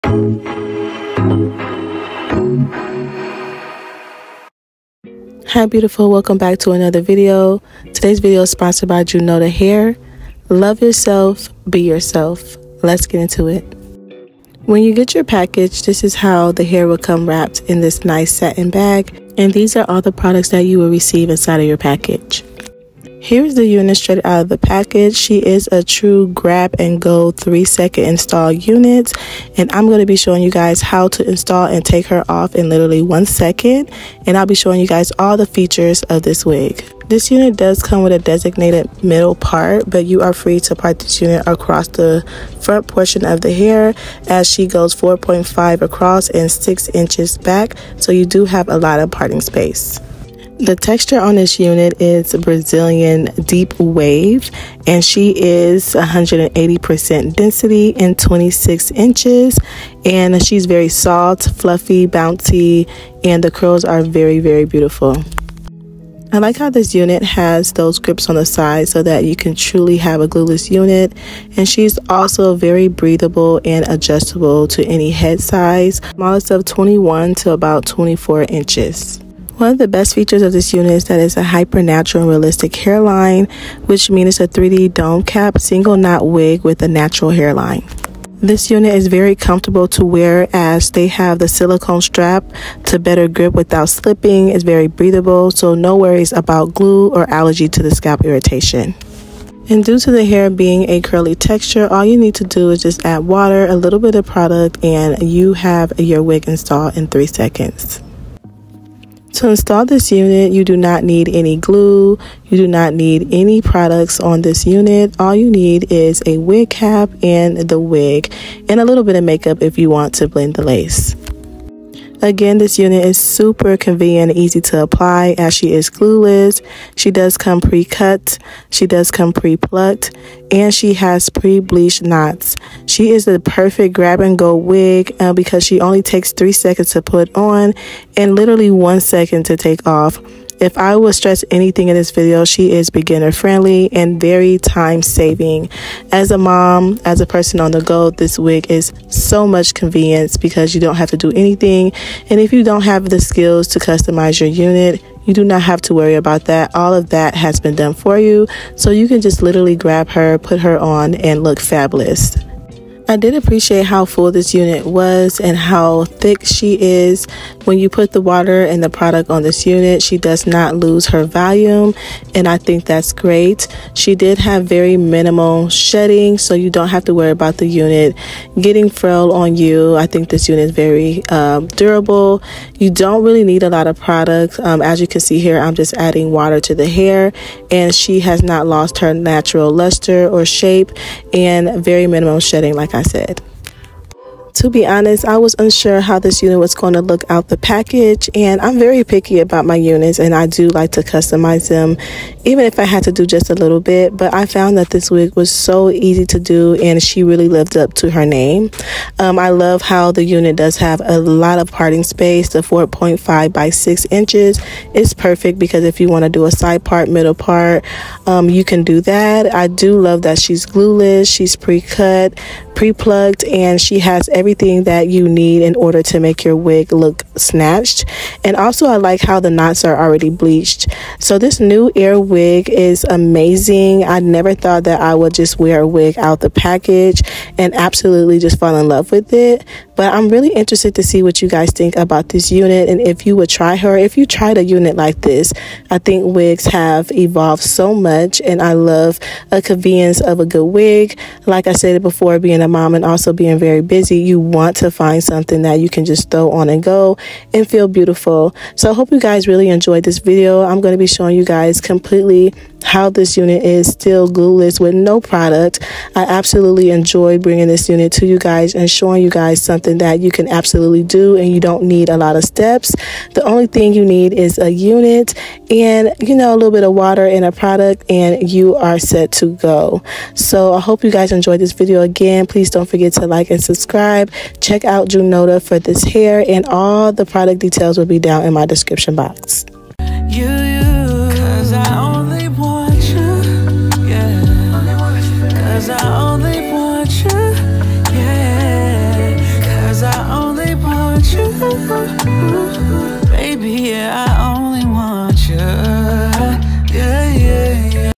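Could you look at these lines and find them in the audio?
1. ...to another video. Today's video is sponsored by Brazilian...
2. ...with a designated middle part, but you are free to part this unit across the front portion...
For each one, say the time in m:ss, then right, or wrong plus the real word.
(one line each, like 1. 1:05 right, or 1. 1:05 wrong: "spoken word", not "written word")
1. 0:06 wrong: "Junoda", not "Brazilian"
2. 0:38 right.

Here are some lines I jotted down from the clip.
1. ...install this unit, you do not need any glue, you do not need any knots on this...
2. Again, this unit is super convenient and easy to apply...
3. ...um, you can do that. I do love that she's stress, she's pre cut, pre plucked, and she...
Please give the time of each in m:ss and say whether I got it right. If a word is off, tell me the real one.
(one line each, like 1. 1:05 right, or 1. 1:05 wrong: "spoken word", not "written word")
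1. 1:49 wrong: "products", not "knots"
2. 2:02 right
3. 3:38 wrong: "glueless", not "stress".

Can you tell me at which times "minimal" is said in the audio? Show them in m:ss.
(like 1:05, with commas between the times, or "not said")
2:54, 3:12.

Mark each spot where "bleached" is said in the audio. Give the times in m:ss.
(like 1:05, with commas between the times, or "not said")
2:11, 3:50.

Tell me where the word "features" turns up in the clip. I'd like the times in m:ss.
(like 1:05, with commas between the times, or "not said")
0:35, 1:20.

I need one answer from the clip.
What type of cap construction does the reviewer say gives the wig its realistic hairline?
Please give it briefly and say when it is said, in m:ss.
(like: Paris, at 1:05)
3D dome cap, at 1:24.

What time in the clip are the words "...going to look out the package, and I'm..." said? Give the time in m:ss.
3:16.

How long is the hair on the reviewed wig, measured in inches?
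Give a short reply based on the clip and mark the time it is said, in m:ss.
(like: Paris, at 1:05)
26 inches, at 0:58.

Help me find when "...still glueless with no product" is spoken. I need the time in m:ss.
4:23.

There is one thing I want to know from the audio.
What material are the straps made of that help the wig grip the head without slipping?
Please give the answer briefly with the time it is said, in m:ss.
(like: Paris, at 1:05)
silicone, at 1:31.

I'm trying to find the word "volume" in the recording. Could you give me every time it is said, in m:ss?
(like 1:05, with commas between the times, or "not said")
2:51.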